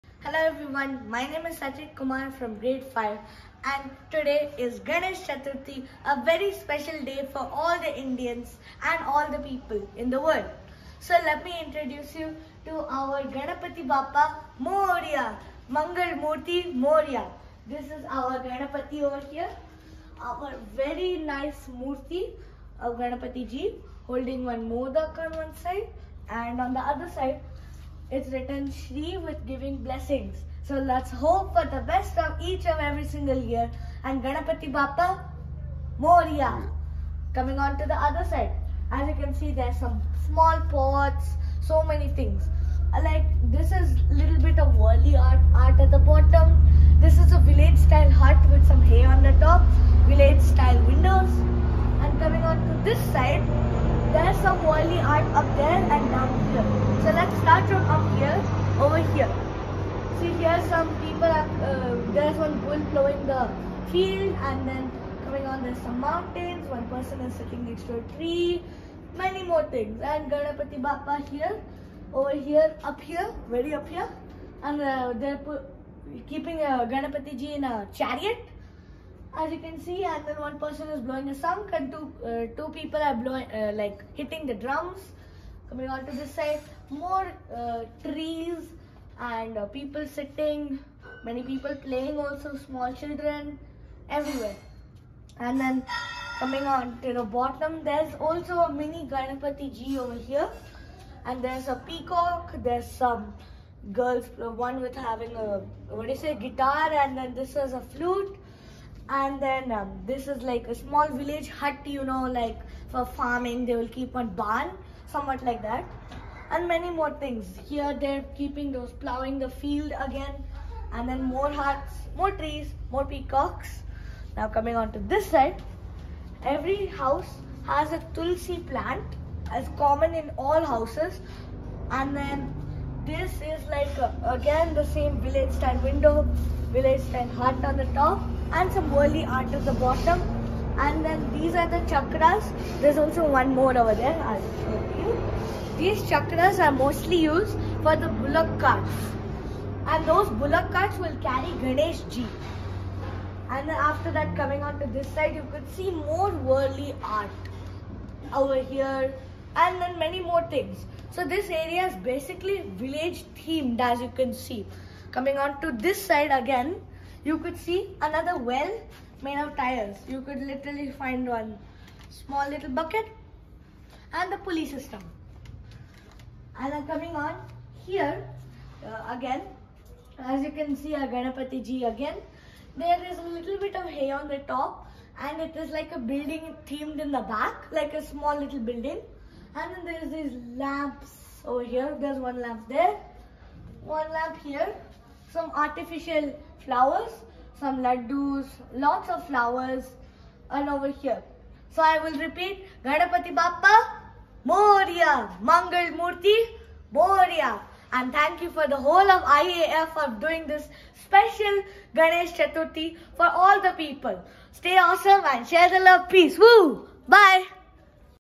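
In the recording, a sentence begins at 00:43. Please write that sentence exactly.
Like this is little bit of Warli art, art at the bottom.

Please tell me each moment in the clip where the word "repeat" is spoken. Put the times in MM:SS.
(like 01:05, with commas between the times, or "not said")
03:22.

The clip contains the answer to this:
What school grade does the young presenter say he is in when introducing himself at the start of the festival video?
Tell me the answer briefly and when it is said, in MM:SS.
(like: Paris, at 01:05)
Grade 5, at 00:02.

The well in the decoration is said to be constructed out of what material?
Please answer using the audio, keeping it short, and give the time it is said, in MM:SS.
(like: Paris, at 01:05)
Tires, at 02:49.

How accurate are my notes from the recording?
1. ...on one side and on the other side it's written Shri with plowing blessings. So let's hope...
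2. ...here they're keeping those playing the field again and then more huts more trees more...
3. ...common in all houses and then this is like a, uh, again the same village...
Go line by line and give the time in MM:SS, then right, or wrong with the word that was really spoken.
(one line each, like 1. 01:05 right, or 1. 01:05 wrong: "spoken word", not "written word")
1. 00:25 wrong: "giving", not "plowing"
2. 01:57 wrong: "plowing", not "playing"
3. 02:09 right.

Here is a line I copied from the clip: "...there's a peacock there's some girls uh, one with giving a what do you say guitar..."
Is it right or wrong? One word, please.
wrong.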